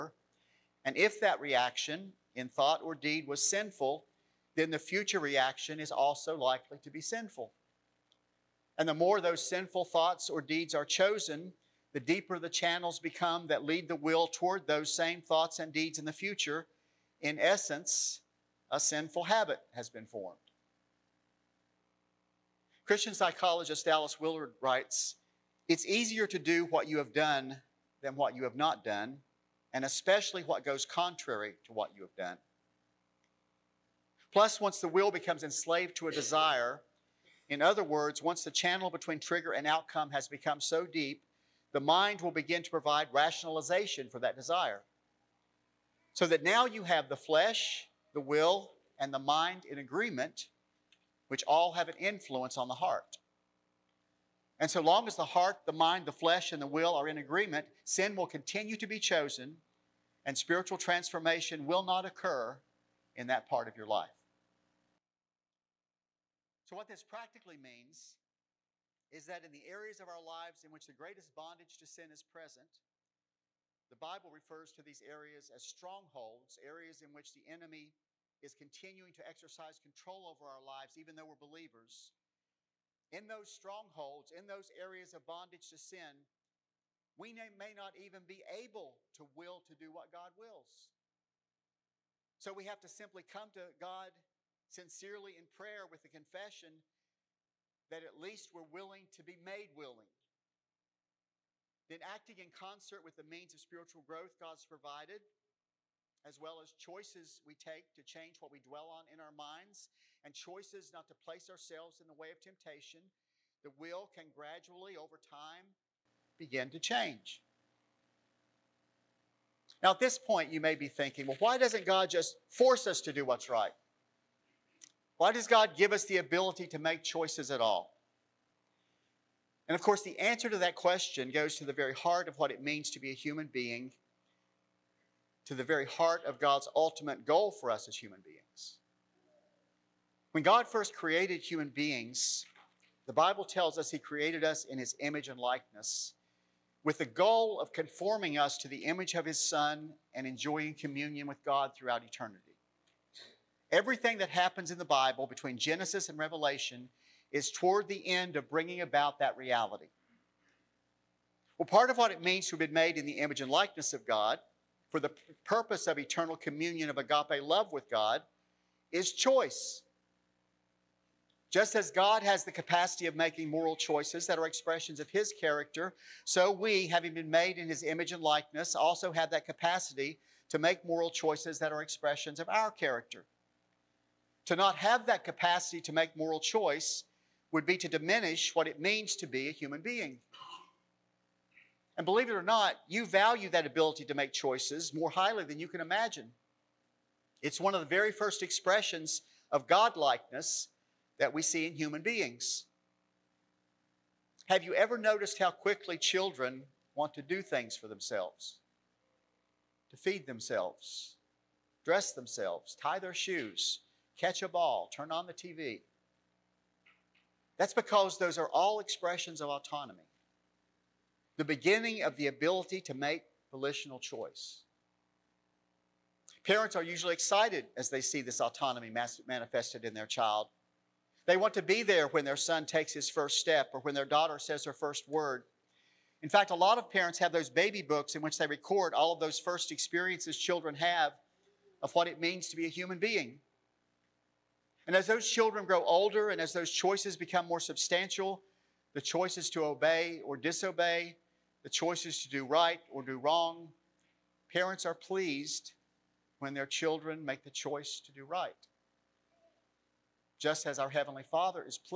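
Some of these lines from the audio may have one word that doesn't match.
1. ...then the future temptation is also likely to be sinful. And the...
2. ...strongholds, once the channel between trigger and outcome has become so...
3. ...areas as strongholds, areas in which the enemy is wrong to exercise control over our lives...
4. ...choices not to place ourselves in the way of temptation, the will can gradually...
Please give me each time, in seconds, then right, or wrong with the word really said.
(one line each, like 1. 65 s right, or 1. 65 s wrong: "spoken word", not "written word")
1. 4 s wrong: "reaction", not "temptation"
2. 37 s wrong: "words", not "strongholds"
3. 75 s wrong: "continuing", not "wrong"
4. 110 s right.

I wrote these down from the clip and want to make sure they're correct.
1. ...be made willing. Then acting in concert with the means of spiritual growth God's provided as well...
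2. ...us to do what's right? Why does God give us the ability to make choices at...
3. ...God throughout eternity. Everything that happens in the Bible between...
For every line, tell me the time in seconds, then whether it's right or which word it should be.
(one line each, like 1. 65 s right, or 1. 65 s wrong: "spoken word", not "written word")
1. 99 s right
2. 122 s right
3. 151 s right.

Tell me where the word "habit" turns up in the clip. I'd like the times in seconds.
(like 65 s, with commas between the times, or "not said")
19 s.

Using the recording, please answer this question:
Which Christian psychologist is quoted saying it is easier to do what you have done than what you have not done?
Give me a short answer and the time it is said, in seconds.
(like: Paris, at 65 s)
Dallas Willard, at 23 s.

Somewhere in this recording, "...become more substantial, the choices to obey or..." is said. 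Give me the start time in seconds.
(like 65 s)
247 s.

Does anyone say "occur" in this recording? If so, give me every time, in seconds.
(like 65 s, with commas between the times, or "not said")
62 s.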